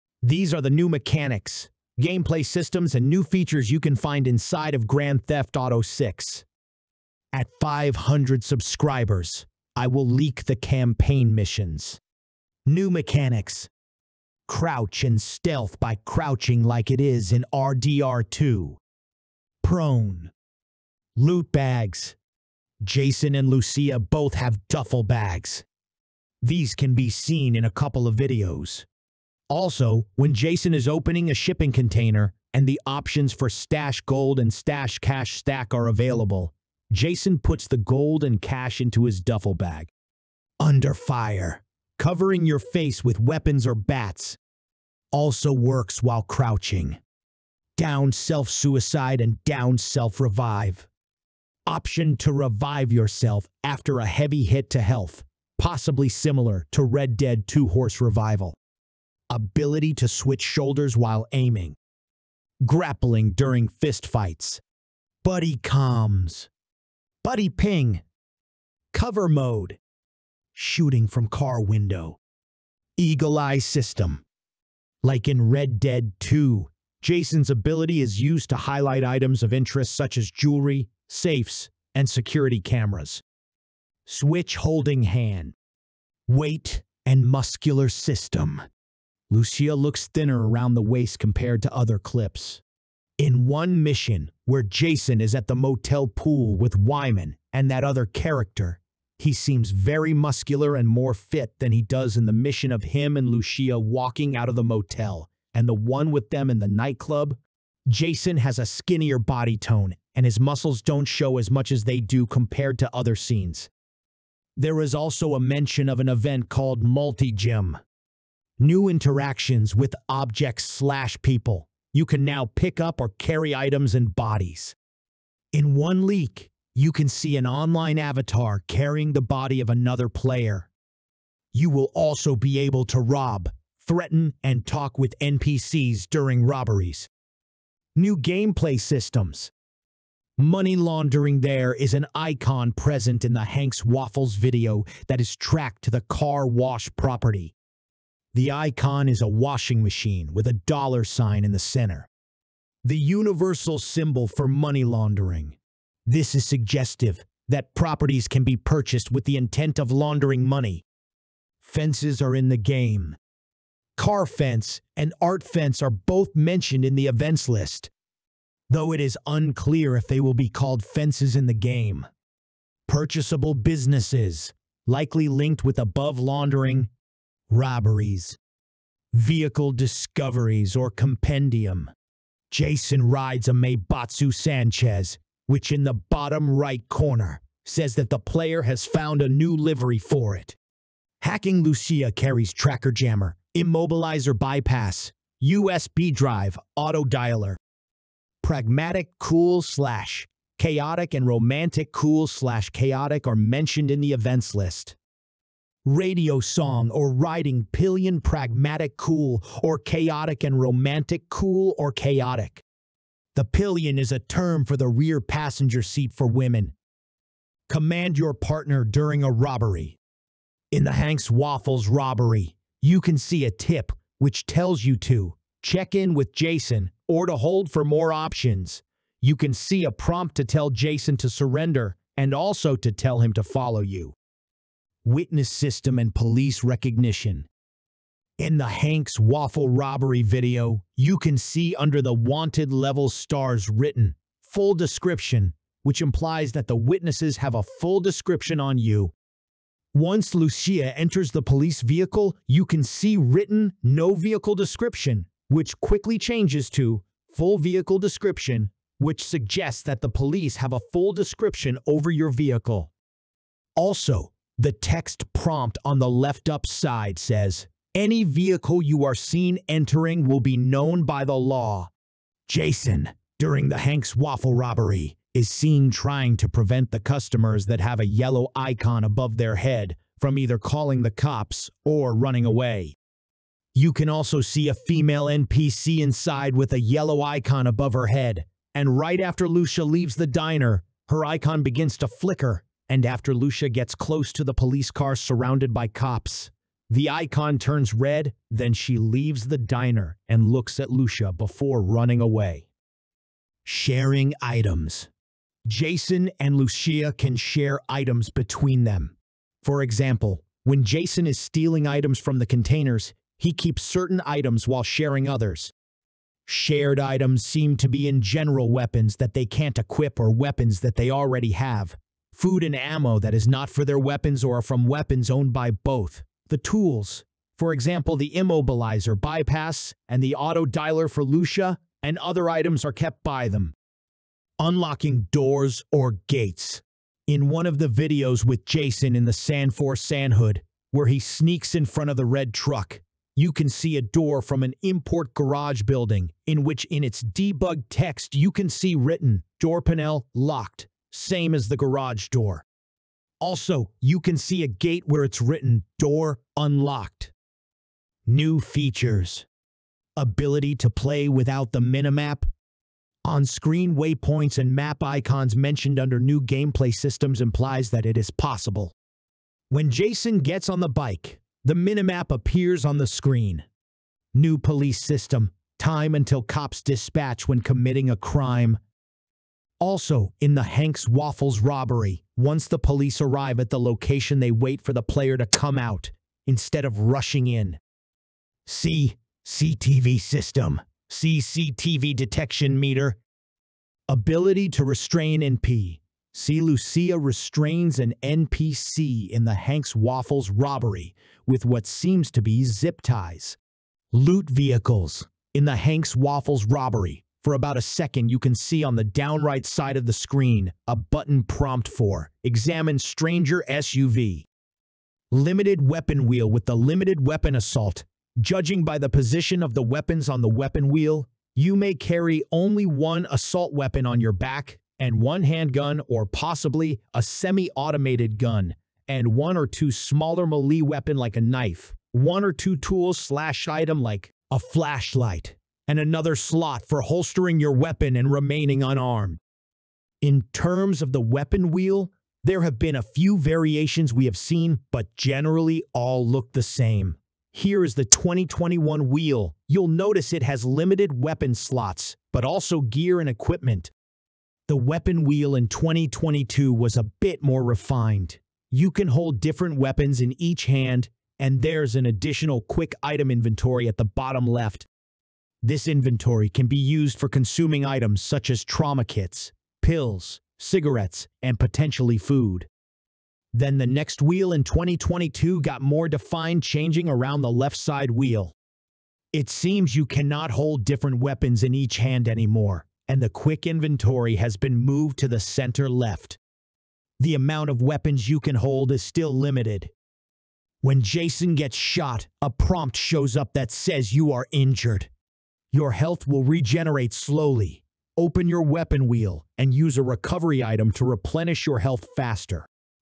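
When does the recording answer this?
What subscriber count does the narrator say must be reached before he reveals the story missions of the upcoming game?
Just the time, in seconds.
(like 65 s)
7 s.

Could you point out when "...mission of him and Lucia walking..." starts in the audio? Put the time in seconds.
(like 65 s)
102 s.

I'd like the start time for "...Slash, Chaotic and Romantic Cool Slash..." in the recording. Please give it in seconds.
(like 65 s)
199 s.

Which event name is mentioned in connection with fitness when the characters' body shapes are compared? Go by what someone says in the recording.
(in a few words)
Multi Gym.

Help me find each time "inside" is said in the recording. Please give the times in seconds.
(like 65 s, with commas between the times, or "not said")
4 s, 285 s.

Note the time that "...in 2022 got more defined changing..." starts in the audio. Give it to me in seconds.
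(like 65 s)
474 s.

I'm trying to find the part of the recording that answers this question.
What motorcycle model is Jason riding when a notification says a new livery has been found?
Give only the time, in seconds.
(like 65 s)
183 s.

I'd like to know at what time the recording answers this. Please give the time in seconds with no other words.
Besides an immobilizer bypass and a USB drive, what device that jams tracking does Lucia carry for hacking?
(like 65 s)
192 s.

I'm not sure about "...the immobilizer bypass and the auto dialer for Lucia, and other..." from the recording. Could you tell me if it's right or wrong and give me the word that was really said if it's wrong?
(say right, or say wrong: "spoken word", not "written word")
right.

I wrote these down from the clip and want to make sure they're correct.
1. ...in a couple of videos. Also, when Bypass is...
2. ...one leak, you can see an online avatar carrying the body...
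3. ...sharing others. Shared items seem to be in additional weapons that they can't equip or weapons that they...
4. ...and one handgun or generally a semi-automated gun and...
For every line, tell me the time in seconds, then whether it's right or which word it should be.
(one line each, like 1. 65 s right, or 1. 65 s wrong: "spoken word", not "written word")
1. 27 s wrong: "Jason", not "Bypass"
2. 125 s right
3. 314 s wrong: "general", not "additional"
4. 424 s wrong: "possibly", not "generally".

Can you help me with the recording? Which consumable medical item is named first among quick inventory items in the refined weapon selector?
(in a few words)
trauma kits.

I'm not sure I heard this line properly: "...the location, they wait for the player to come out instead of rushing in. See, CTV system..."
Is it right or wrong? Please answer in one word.
right.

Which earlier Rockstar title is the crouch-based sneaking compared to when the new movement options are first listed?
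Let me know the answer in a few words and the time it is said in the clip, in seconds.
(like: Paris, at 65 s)
RDR2, at 17 s.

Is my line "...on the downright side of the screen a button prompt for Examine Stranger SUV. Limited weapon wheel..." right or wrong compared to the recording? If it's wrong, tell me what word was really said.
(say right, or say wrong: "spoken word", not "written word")
right.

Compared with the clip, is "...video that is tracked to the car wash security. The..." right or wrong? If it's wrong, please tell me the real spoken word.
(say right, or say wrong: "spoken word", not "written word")
wrong: "property", not "security".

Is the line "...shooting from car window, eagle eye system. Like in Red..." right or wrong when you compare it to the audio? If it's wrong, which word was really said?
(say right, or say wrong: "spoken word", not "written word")
right.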